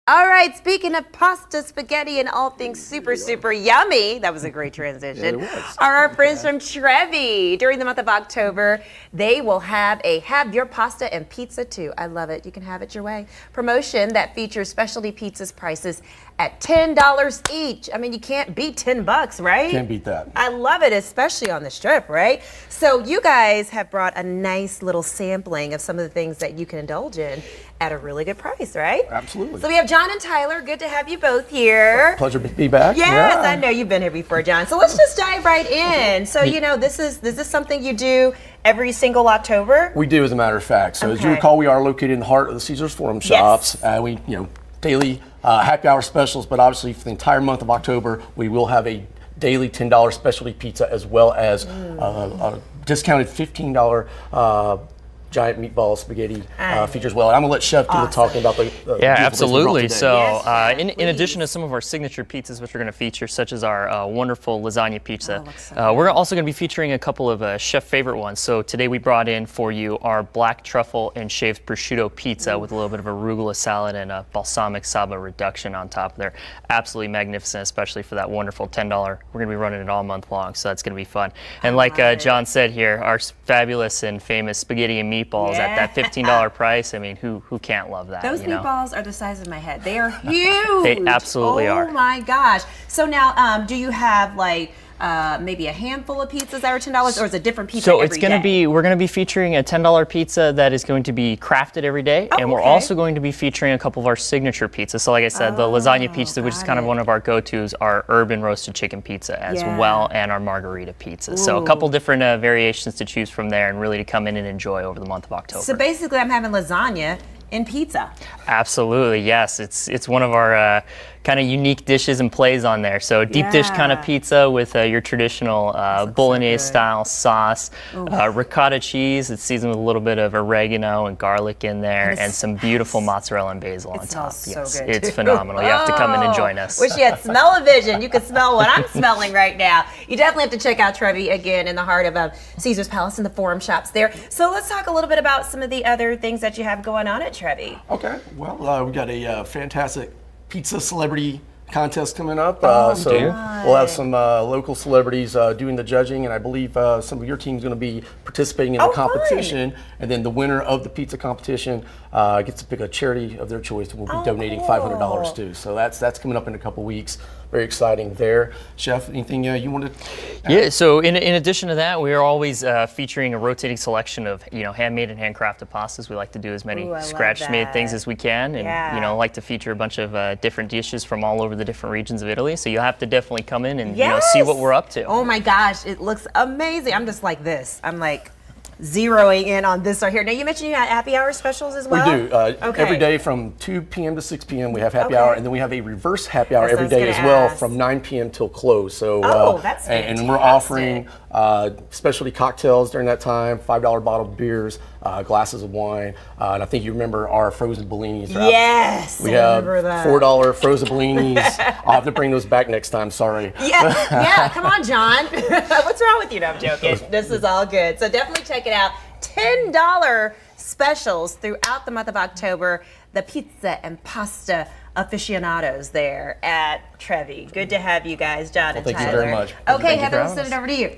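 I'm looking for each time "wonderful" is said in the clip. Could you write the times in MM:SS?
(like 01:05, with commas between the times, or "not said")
01:04, 01:18.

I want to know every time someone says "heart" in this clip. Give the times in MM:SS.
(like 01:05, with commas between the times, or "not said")
00:42, 02:21.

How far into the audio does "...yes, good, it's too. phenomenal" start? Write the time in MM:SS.
02:14.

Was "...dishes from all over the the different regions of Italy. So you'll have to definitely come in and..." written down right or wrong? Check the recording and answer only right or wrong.
right.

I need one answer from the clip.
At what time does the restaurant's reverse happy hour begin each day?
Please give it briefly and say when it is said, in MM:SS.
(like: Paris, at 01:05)
9 p.m., at 03:17.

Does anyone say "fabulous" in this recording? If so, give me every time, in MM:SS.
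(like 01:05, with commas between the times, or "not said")
01:23.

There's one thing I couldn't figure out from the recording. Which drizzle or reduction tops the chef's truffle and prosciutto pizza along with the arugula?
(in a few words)
balsamic saba reduction.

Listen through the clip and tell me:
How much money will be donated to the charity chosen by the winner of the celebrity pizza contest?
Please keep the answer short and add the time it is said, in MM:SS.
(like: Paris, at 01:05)
$500, at 02:44.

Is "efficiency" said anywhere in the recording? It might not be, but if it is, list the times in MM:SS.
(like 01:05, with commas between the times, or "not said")
not said.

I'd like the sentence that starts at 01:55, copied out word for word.
So basically, I'm having lasagna in pizza.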